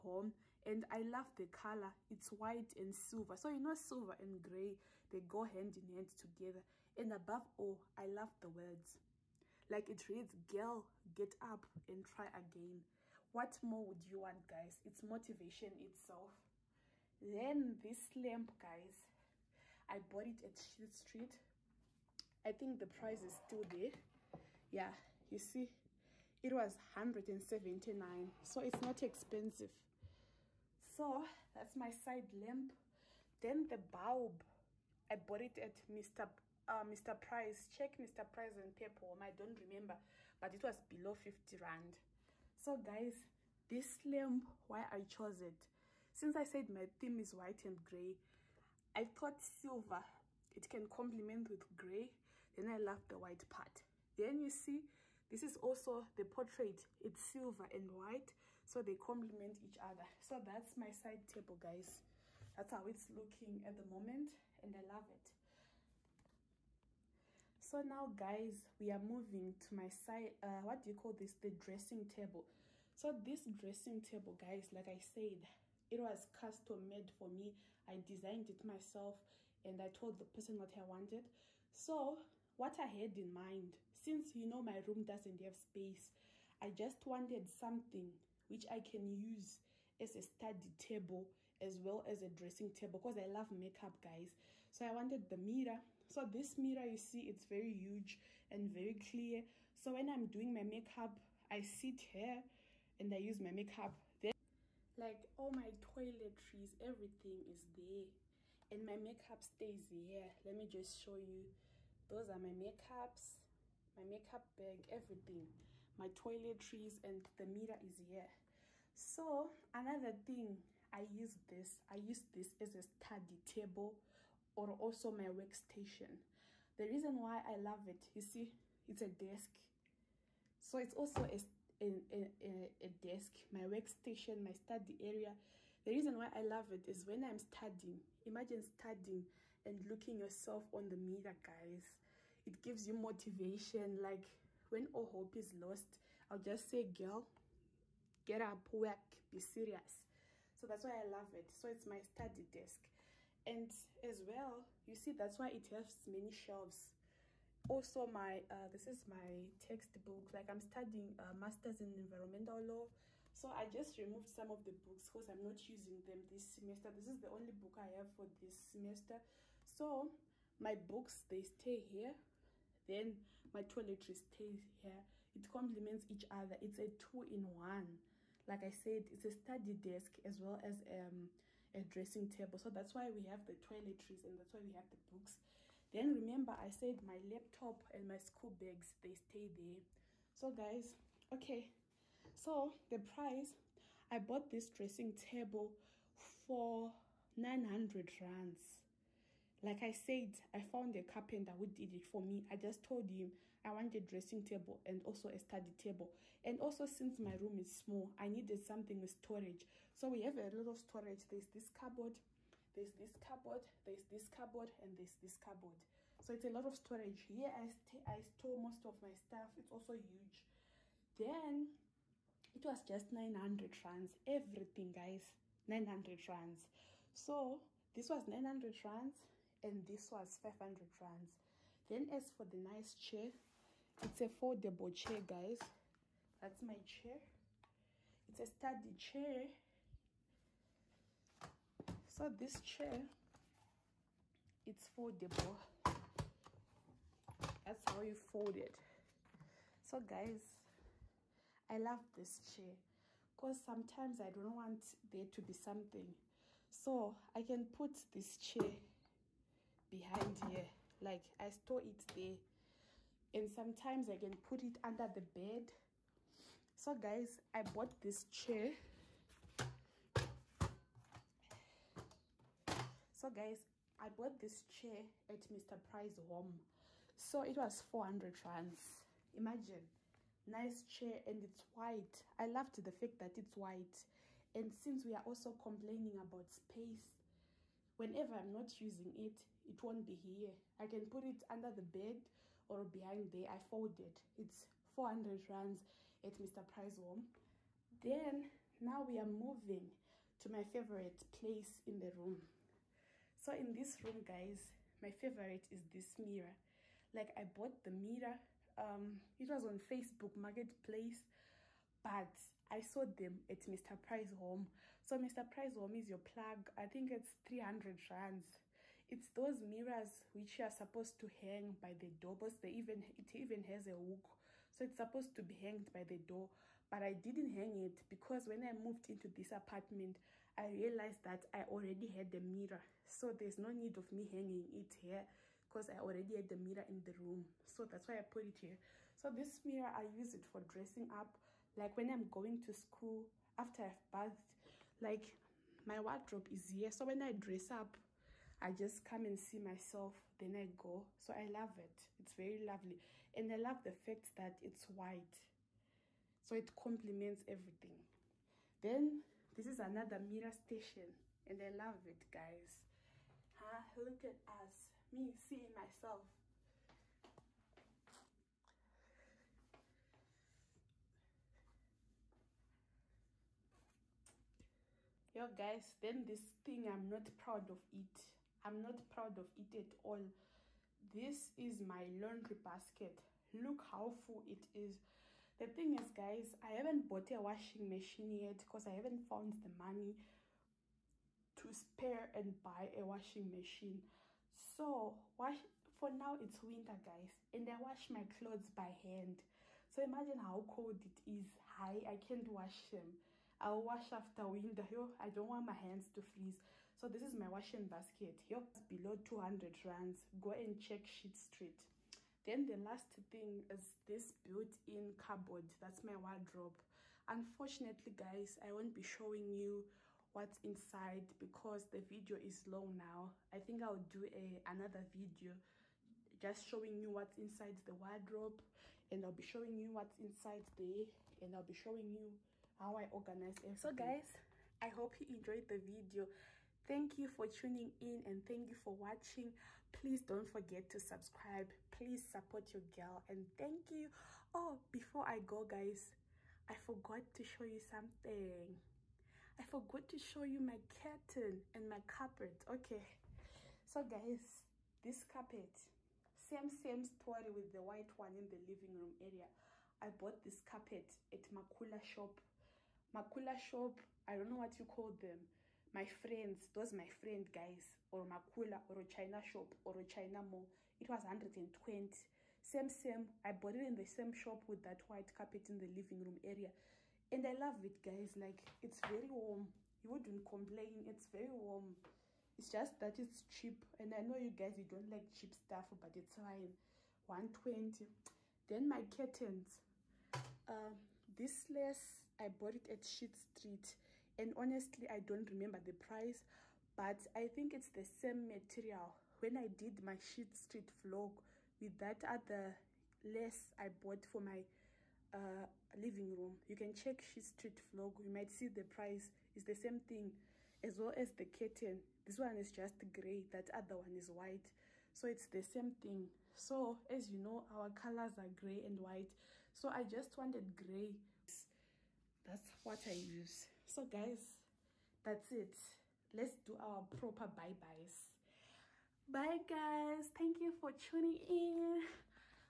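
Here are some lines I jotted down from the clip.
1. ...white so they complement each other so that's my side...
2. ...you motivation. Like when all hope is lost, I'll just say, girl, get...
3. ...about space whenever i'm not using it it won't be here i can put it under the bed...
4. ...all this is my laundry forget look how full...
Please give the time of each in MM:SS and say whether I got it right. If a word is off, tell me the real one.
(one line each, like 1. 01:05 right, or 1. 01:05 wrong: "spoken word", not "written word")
1. 00:57 right
2. 02:22 right
3. 04:46 right
4. 06:20 wrong: "basket", not "forget".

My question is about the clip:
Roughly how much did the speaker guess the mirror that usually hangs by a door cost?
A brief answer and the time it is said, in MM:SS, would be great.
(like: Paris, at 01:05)
300 rands, at 05:17.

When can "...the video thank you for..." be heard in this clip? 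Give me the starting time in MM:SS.
07:15.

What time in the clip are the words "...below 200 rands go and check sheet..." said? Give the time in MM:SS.
06:48.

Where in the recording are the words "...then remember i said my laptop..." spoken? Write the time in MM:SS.
03:05.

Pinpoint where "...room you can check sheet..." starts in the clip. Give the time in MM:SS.
08:26.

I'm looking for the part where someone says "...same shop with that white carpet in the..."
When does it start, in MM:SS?
07:54.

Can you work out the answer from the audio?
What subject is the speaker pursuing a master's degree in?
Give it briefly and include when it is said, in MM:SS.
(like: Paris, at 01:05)
environmental law, at 02:41.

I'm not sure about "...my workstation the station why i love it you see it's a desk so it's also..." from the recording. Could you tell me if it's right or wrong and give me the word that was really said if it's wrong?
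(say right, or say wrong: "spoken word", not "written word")
wrong: "reason", not "station".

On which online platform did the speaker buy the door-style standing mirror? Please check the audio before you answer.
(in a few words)
Facebook Marketplace.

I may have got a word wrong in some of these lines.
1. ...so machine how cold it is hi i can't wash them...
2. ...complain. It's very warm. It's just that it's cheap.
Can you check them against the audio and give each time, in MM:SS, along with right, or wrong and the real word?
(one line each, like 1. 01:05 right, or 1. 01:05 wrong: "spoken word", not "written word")
1. 06:39 wrong: "imagine", not "machine"
2. 08:00 right.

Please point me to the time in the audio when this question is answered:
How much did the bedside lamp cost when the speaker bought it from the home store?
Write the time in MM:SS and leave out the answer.
00:26.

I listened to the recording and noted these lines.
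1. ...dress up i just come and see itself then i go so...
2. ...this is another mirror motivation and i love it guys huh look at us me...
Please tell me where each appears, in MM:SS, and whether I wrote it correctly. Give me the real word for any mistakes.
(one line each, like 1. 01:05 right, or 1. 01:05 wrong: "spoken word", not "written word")
1. 05:47 wrong: "myself", not "itself"
2. 05:59 wrong: "station", not "motivation".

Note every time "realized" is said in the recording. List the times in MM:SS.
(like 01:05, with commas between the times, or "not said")
05:30.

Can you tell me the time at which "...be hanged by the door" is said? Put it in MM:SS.
05:25.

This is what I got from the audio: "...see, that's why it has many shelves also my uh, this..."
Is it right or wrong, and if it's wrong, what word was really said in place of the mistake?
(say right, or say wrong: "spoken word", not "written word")
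right.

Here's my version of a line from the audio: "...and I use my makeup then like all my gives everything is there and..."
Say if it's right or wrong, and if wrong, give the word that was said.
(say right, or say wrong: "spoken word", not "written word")
wrong: "toiletries", not "gives".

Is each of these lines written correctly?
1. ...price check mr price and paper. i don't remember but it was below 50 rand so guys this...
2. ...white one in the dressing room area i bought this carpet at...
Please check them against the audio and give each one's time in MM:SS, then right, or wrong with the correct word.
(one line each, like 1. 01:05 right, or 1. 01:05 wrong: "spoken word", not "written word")
1. 00:37 right
2. 07:37 wrong: "living", not "dressing".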